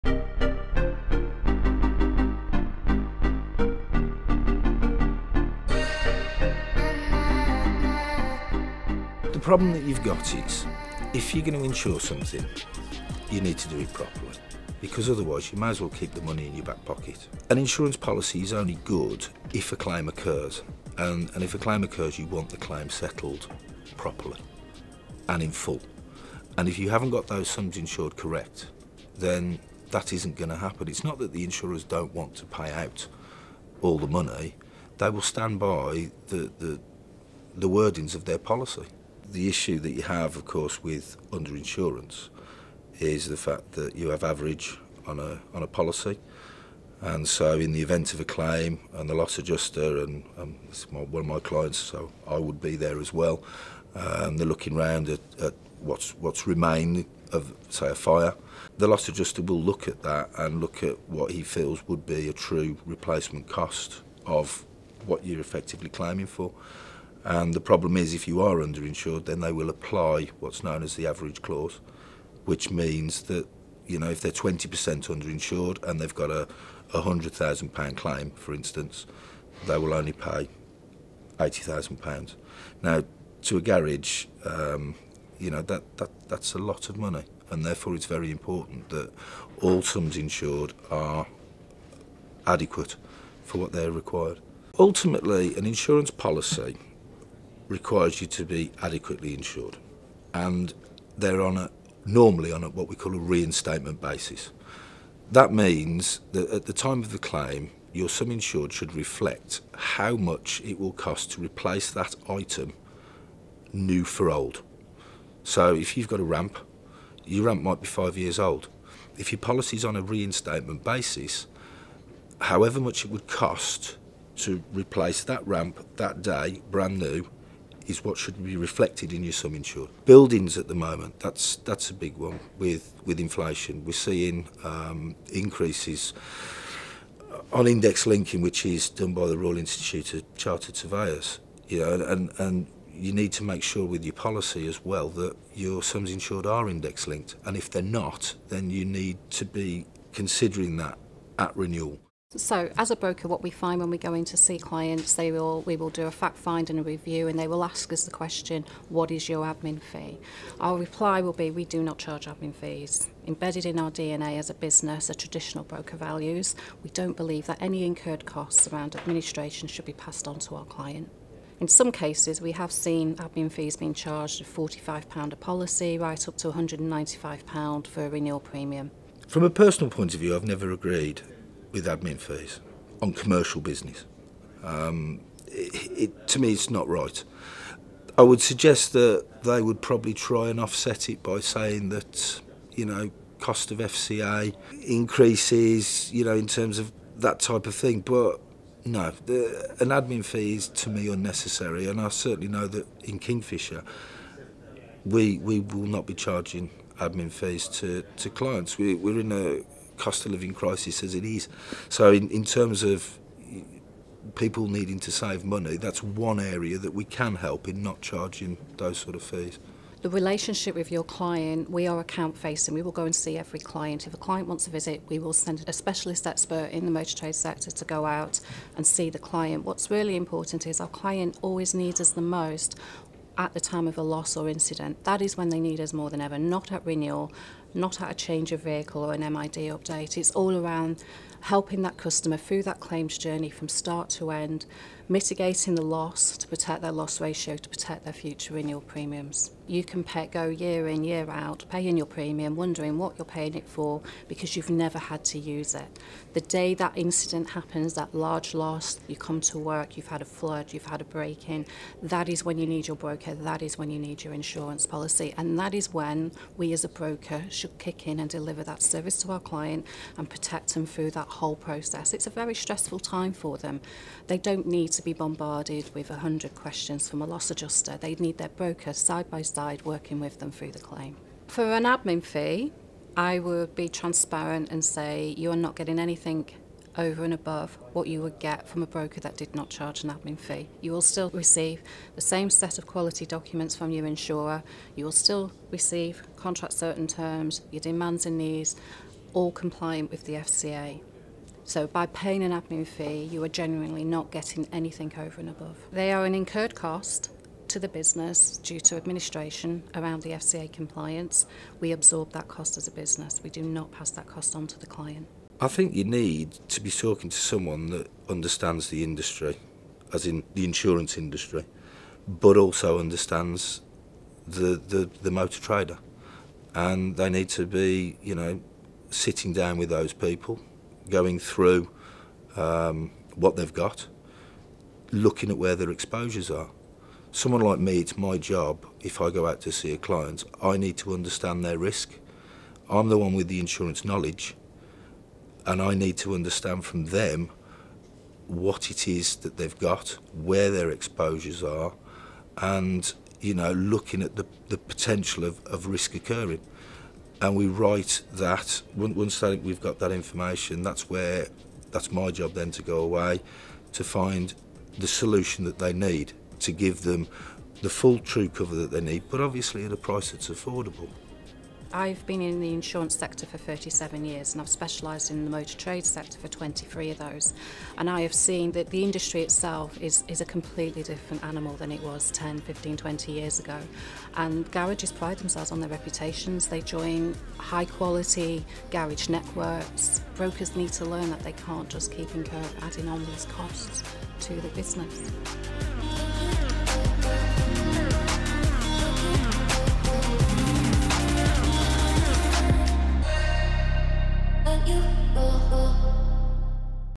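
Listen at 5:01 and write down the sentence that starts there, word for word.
So by paying an admin fee, you are genuinely not getting anything over and above.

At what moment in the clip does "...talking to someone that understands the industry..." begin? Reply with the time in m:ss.
5:16.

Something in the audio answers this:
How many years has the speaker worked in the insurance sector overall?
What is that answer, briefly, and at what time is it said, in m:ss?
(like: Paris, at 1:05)
37 years, at 6:13.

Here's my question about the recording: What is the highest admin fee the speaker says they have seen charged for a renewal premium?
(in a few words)
£195.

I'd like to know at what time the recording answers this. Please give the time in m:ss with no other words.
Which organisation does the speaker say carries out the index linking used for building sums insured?
2:19.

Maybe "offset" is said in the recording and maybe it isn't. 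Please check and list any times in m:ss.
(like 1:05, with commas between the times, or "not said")
3:10.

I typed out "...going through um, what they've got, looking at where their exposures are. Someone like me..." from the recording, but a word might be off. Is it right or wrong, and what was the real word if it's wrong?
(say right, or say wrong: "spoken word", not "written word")
right.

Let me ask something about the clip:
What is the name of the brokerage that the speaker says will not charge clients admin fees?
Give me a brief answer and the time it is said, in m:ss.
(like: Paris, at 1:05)
Kingfisher, at 3:23.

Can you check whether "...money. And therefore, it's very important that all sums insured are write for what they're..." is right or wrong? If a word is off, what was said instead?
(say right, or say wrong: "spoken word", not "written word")
wrong: "adequate", not "write".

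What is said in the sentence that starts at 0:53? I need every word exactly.
Um, they're looking round at, at what's what's remained of say a fire.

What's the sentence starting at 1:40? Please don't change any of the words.
And they're on a, normally on a, what we call a reinstatement basis.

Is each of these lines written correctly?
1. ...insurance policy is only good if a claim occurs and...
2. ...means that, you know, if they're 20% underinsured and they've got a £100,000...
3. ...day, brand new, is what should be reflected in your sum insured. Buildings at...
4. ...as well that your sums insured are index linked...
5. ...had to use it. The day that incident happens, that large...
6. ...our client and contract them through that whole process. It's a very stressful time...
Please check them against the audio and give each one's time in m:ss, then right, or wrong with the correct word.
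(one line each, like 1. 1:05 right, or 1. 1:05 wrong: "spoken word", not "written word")
1. 0:17 right
2. 1:12 right
3. 2:06 right
4. 2:24 right
5. 4:14 right
6. 4:29 wrong: "protect", not "contract".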